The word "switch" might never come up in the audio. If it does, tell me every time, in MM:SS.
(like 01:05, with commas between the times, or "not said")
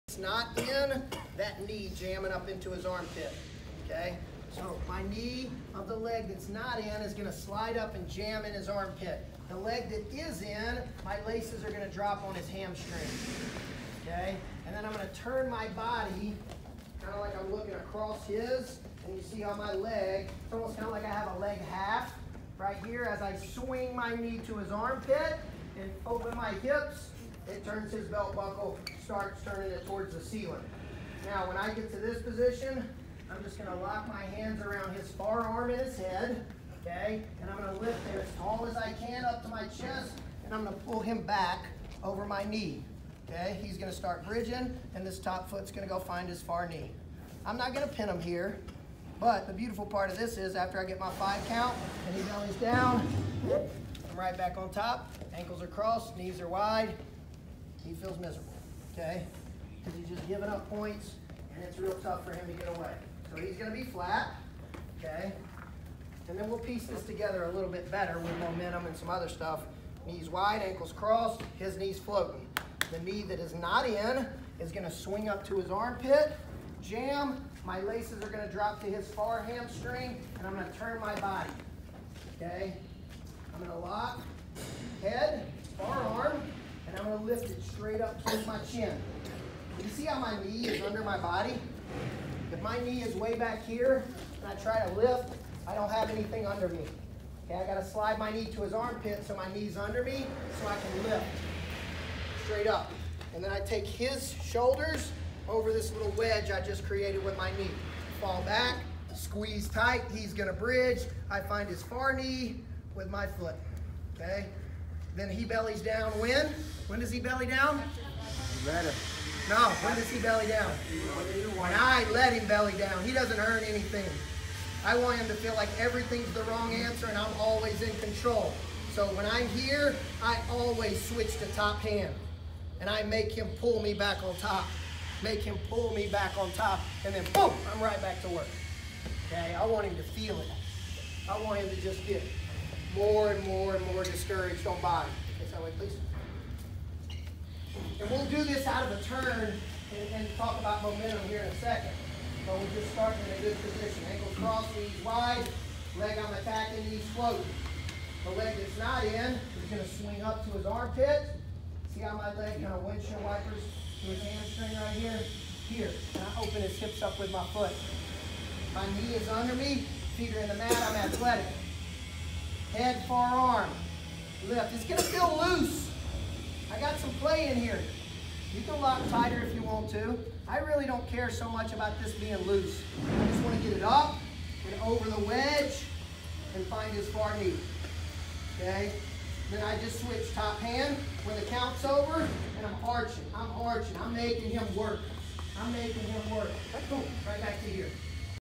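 02:11, 03:09.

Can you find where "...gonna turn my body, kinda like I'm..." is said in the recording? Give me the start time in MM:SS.
00:14.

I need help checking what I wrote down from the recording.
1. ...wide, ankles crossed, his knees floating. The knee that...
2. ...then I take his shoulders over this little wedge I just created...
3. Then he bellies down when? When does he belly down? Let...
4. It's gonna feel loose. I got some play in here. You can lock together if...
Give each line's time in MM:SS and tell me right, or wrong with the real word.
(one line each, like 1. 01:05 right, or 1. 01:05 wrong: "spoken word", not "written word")
1. 01:10 right
2. 01:43 right
3. 01:55 right
4. 02:54 wrong: "tighter", not "together".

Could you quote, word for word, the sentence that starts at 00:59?
Because he's just giving up points, and it's real tough for him to get away.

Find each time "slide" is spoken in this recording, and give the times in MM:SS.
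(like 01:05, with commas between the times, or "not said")
00:07, 01:37.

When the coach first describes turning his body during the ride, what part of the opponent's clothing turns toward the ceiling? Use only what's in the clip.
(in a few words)
belt buckle.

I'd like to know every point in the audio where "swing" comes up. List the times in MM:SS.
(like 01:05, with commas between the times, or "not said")
00:23, 01:14, 02:39.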